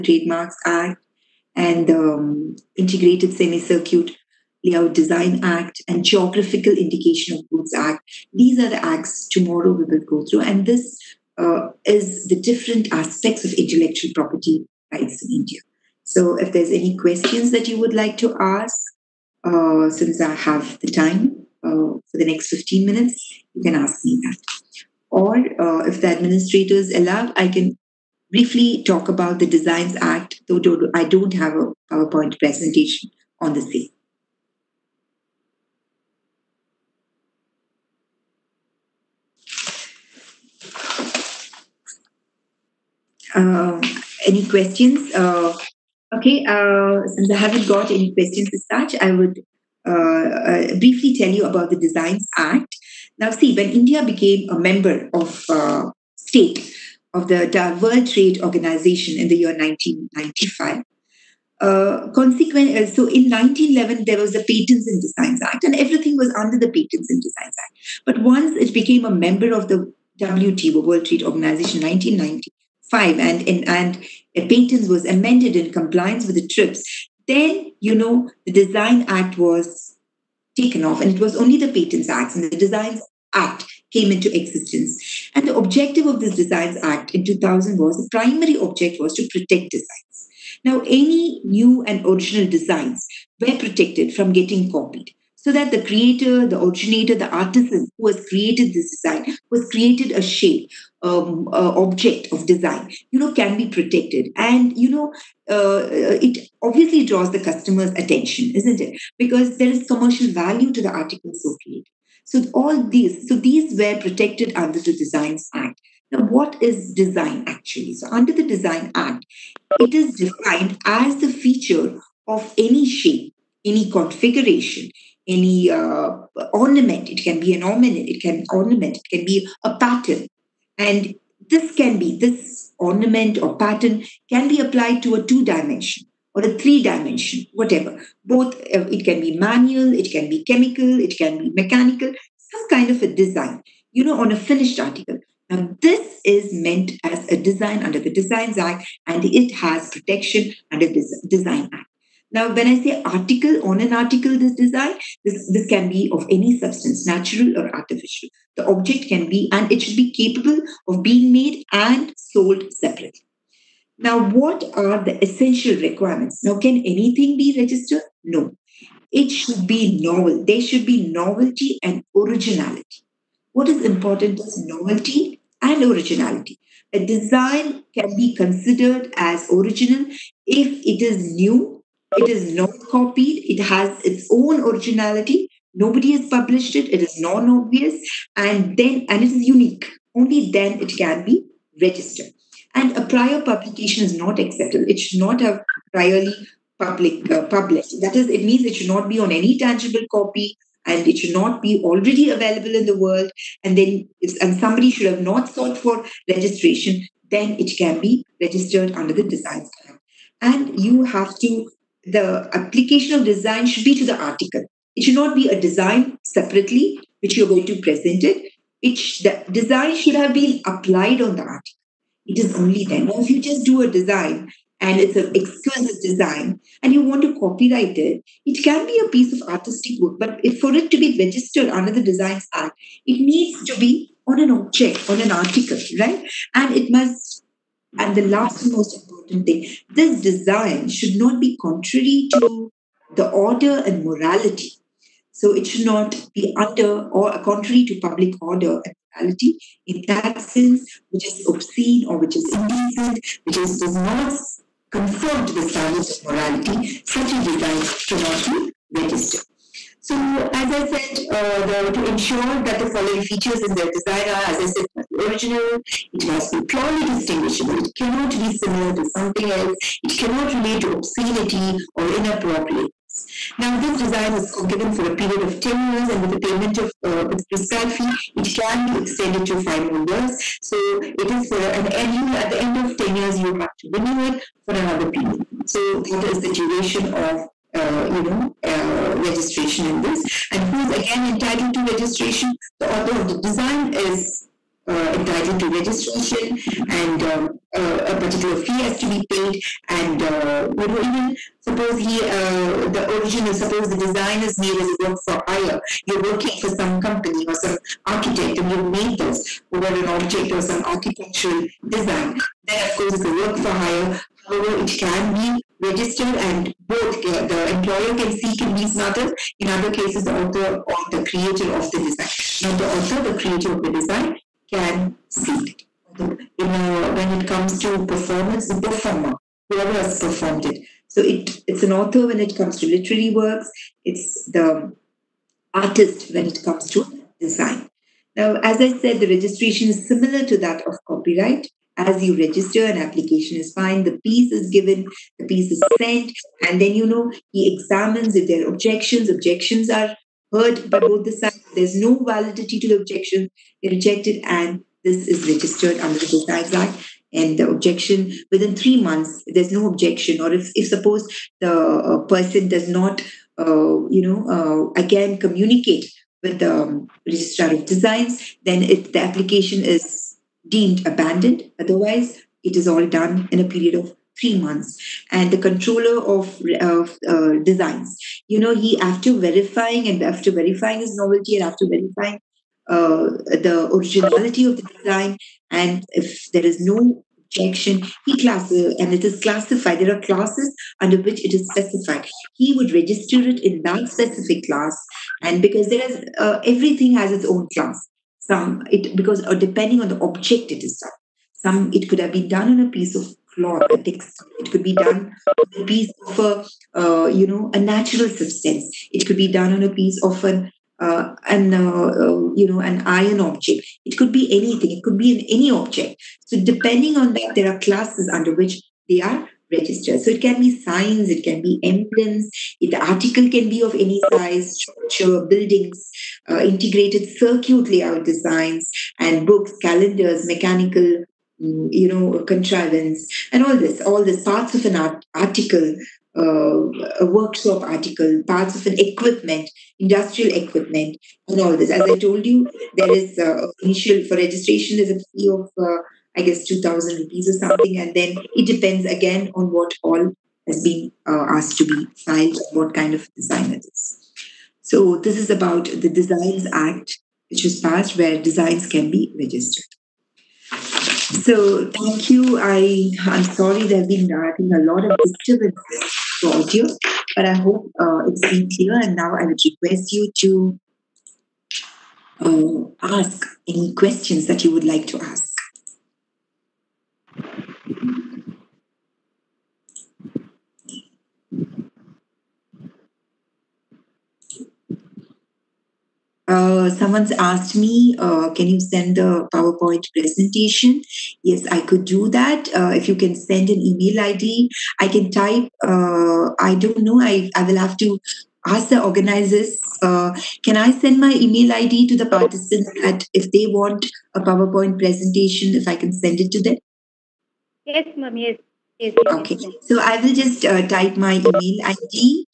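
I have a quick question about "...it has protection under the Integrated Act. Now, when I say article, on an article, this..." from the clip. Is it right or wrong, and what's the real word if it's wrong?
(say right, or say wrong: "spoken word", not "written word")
wrong: "Design", not "Integrated".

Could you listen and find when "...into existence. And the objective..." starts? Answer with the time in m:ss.
1:24.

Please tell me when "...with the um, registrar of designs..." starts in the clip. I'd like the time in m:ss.
6:06.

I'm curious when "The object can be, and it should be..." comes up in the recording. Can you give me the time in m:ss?
2:38.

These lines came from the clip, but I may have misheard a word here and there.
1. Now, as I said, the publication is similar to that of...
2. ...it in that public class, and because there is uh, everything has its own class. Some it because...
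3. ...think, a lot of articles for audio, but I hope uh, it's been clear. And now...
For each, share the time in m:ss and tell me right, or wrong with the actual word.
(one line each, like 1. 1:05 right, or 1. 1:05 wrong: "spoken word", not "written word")
1. 5:38 wrong: "registration", not "publication"
2. 6:33 wrong: "specific", not "public"
3. 7:44 wrong: "disturbances", not "articles".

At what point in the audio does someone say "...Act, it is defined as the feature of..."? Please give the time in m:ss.
1:58.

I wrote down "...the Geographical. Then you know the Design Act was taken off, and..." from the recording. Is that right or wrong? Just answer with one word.
wrong.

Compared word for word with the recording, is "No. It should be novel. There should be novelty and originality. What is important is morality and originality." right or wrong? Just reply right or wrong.
wrong.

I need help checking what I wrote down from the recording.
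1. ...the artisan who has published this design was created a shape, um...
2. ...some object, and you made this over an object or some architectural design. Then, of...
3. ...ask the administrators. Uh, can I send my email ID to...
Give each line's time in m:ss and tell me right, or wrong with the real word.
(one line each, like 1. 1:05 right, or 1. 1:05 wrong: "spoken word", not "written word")
1. 1:37 wrong: "created", not "published"
2. 5:07 wrong: "architect", not "object"
3. 8:18 wrong: "organizers", not "administrators".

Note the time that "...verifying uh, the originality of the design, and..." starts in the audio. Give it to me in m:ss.
6:21.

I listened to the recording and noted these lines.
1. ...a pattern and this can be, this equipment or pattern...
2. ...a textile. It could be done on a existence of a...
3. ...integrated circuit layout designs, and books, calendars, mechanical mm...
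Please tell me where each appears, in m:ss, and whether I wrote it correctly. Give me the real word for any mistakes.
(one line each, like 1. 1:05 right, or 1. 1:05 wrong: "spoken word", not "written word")
1. 2:09 wrong: "ornament", not "equipment"
2. 6:43 wrong: "piece", not "existence"
3. 7:06 right.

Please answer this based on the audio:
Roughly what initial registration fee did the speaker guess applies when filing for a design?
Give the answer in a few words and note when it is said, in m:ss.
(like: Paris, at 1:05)
2,000 rupees, at 7:26.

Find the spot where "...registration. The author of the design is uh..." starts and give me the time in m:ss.
4:51.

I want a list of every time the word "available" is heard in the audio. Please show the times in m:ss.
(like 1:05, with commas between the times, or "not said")
3:22.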